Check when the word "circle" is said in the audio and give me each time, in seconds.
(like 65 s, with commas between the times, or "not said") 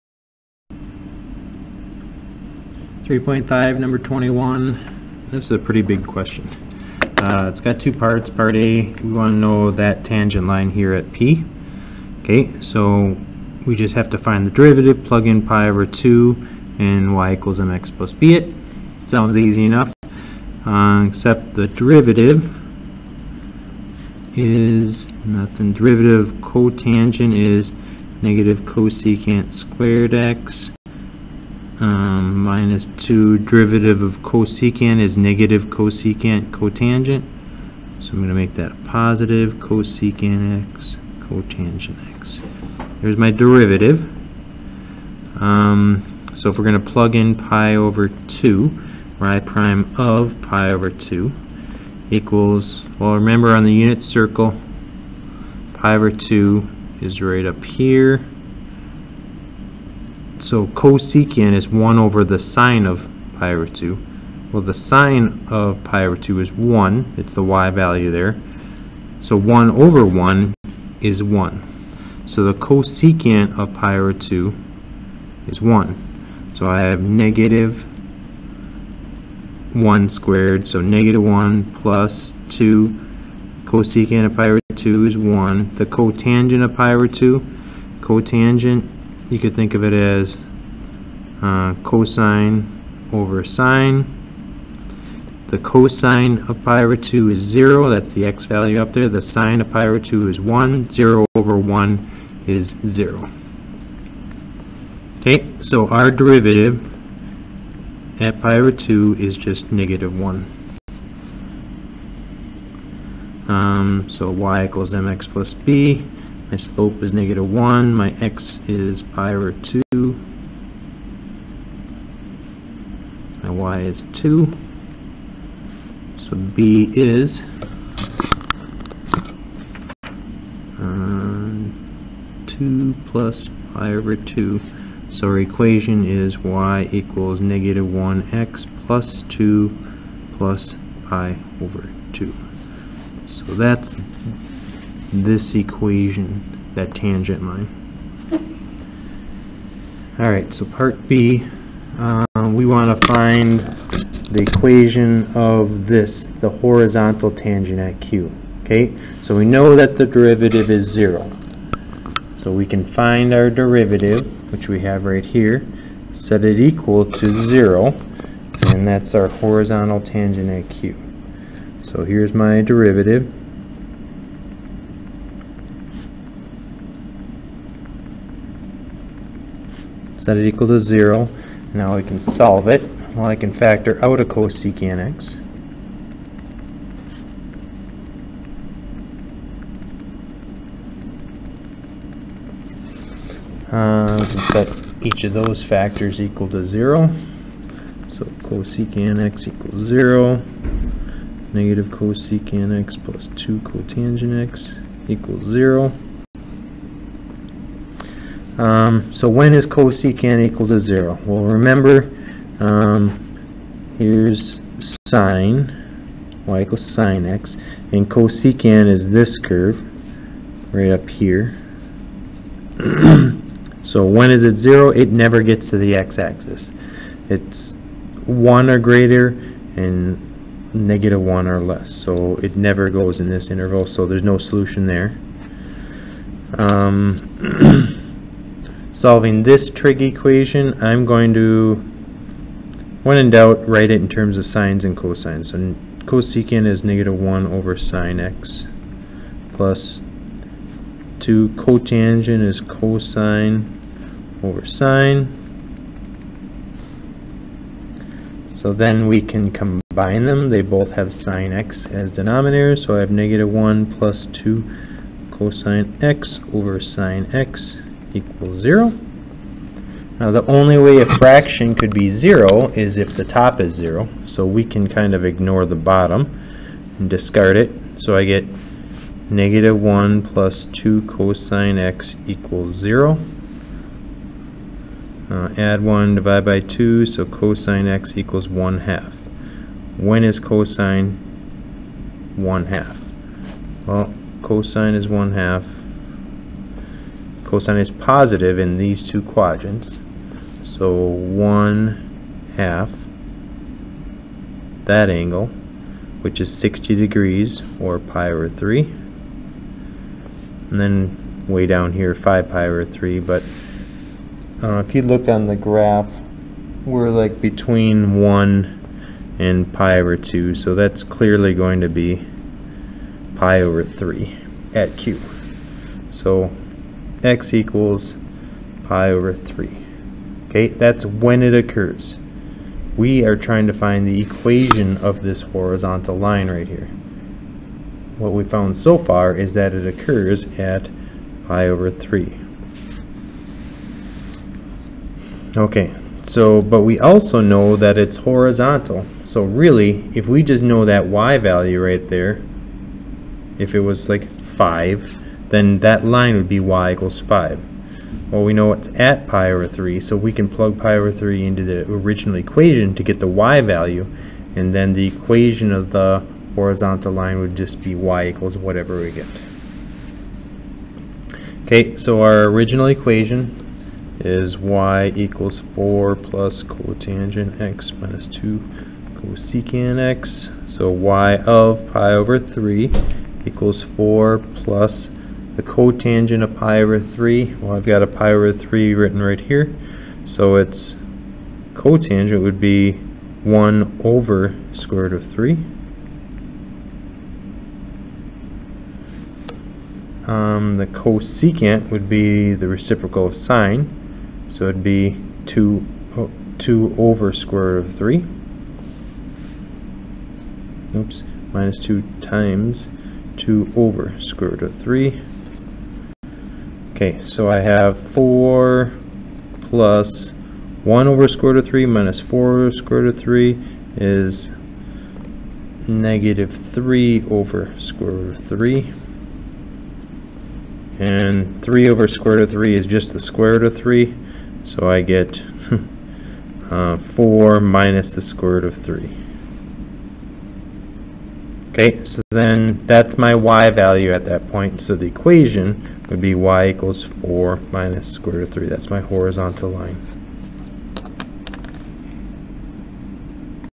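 54 s.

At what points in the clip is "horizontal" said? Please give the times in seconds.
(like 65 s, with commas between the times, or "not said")
156 s, 169 s, 335 s, 348 s, 366 s, 448 s.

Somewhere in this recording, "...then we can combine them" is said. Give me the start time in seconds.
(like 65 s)
258 s.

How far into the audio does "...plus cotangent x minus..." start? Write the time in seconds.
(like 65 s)
376 s.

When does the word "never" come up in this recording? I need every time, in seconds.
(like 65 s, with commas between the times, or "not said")
225 s, 232 s.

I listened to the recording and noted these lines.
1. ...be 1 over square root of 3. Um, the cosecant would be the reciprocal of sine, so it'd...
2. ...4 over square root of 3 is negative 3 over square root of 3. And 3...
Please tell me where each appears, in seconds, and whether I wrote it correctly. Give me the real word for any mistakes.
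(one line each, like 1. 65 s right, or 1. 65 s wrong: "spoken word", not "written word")
1. 392 s right
2. 422 s right.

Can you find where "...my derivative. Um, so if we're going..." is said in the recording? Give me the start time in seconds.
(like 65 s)
43 s.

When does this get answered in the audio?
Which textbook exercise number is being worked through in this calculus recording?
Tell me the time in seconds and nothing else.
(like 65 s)
3 s.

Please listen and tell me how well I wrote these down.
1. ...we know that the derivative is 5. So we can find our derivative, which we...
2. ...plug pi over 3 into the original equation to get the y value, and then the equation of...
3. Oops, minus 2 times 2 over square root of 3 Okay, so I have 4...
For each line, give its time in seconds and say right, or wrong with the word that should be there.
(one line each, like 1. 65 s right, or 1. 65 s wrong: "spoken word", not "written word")
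1. 159 s wrong: "0", not "5"
2. 360 s right
3. 410 s right.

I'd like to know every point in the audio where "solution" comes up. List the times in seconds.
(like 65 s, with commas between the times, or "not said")
234 s.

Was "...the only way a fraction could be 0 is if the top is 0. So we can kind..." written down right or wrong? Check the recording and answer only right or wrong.
right.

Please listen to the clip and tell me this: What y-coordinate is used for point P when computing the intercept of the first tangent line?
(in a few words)
2.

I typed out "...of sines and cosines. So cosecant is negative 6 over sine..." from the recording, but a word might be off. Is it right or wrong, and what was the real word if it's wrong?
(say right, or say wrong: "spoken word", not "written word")
wrong: "1", not "6".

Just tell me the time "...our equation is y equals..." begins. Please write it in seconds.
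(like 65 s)
135 s.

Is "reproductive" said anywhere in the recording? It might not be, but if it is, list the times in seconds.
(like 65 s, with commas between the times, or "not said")
not said.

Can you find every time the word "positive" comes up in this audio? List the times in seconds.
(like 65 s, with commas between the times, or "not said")
38 s, 297 s.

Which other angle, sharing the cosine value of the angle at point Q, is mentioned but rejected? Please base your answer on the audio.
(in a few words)
5pi/3.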